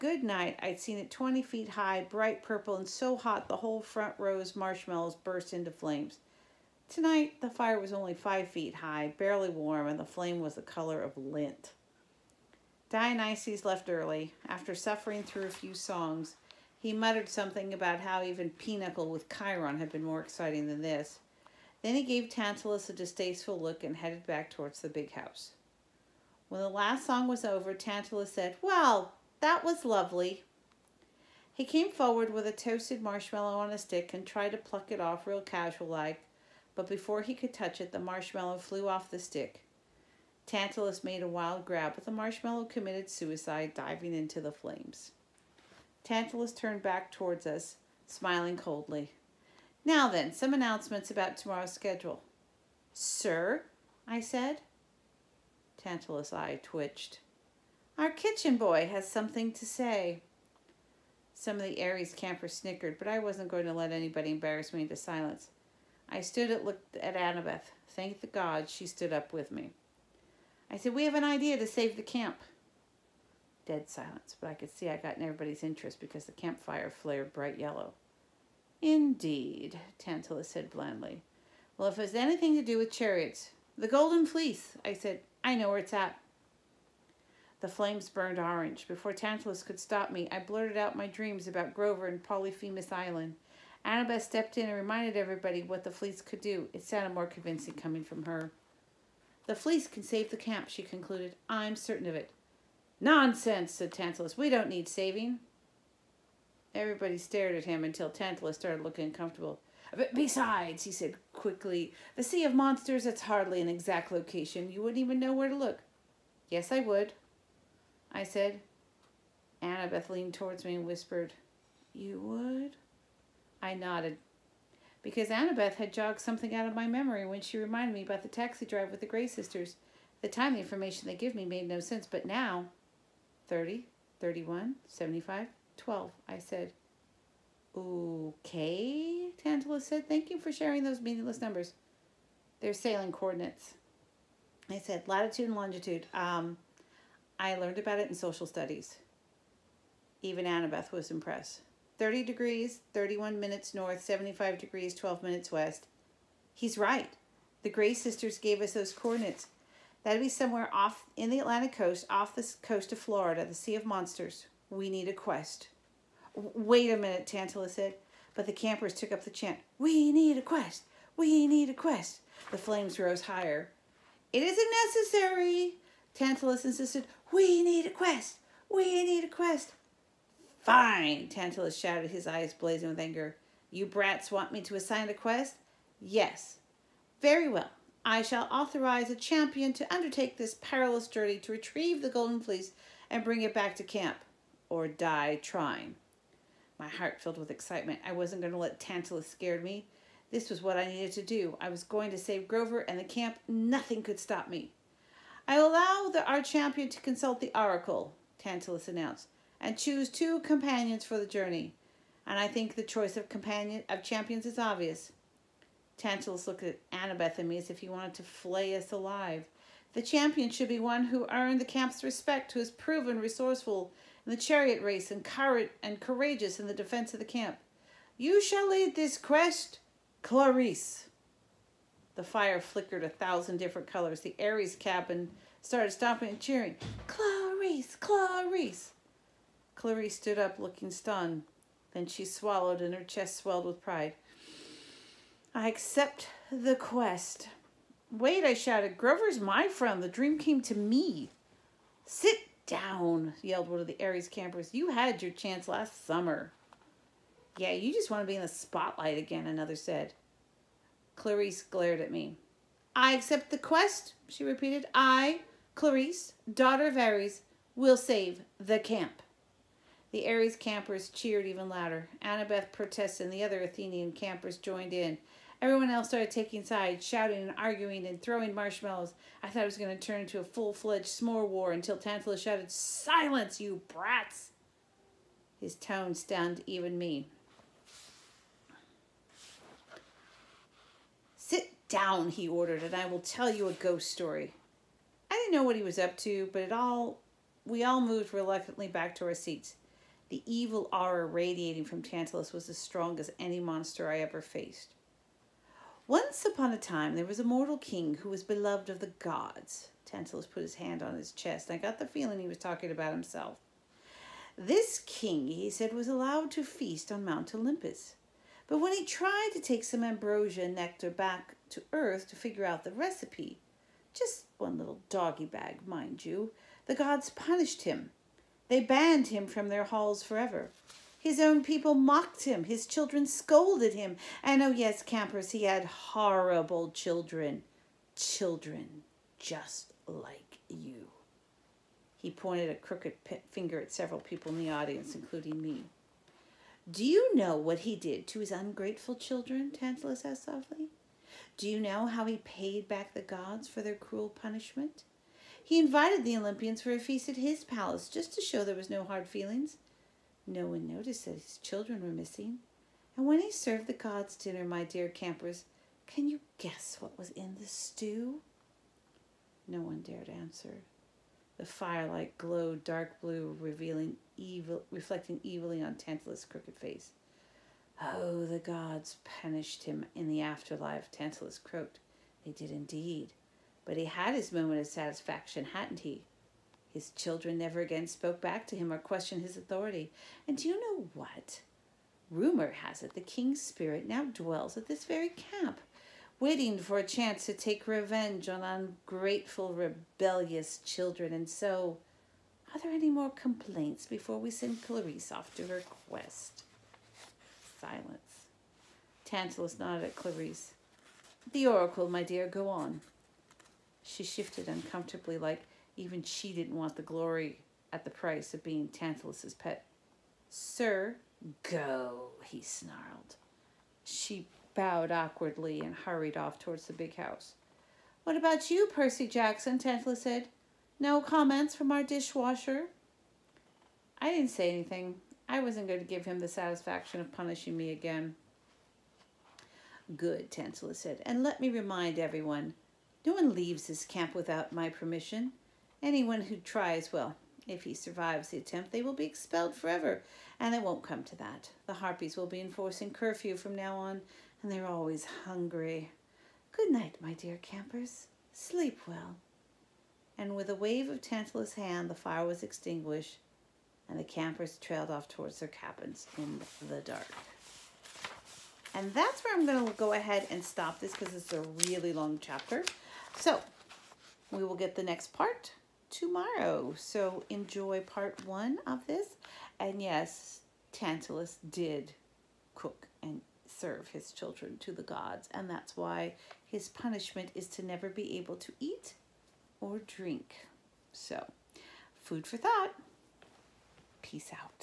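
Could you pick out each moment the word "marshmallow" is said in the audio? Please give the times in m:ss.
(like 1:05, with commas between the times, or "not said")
0:04, 0:33, 0:37, 0:42, 4:38.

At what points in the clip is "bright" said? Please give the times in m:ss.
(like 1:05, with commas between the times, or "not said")
0:02, 1:17.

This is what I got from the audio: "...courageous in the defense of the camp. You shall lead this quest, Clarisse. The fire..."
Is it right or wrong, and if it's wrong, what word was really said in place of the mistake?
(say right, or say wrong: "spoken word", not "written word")
right.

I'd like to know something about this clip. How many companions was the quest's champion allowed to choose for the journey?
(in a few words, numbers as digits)
2.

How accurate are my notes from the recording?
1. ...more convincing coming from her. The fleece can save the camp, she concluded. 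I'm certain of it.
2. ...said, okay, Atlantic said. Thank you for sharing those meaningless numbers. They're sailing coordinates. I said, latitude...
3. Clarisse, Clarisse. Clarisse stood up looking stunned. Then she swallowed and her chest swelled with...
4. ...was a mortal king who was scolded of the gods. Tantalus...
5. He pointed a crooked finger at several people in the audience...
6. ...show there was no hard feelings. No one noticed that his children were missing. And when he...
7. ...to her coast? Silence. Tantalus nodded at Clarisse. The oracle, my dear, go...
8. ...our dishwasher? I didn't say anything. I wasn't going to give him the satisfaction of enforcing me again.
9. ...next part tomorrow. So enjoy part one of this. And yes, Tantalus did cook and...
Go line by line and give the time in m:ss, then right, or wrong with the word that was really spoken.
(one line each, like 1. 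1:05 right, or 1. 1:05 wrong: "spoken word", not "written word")
1. 1:37 right
2. 2:16 wrong: "Tantalus", not "Atlantic"
3. 3:57 right
4. 5:07 wrong: "beloved", not "scolded"
5. 5:42 right
6. 5:58 right
7. 6:45 wrong: "quest", not "coast"
8. 7:11 wrong: "punishing", not "enforcing"
9. 7:55 right.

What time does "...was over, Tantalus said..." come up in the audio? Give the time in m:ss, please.
0:27.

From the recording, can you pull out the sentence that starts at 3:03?
You brats want me to assign a quest?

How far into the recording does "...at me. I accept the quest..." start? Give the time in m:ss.
4:21.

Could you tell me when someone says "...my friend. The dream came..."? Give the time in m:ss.
4:09.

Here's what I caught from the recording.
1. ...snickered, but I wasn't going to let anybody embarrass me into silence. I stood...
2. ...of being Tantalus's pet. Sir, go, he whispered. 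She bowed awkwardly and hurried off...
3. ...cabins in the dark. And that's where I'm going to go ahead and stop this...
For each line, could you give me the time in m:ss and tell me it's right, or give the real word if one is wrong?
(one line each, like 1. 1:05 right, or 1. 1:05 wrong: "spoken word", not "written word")
1. 1:02 right
2. 6:58 wrong: "snarled", not "whispered"
3. 7:45 right.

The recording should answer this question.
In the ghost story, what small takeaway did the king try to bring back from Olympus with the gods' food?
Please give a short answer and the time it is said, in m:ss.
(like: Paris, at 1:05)
Doggy bag, at 5:25.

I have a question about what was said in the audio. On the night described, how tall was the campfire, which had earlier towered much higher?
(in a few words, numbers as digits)
5 feet.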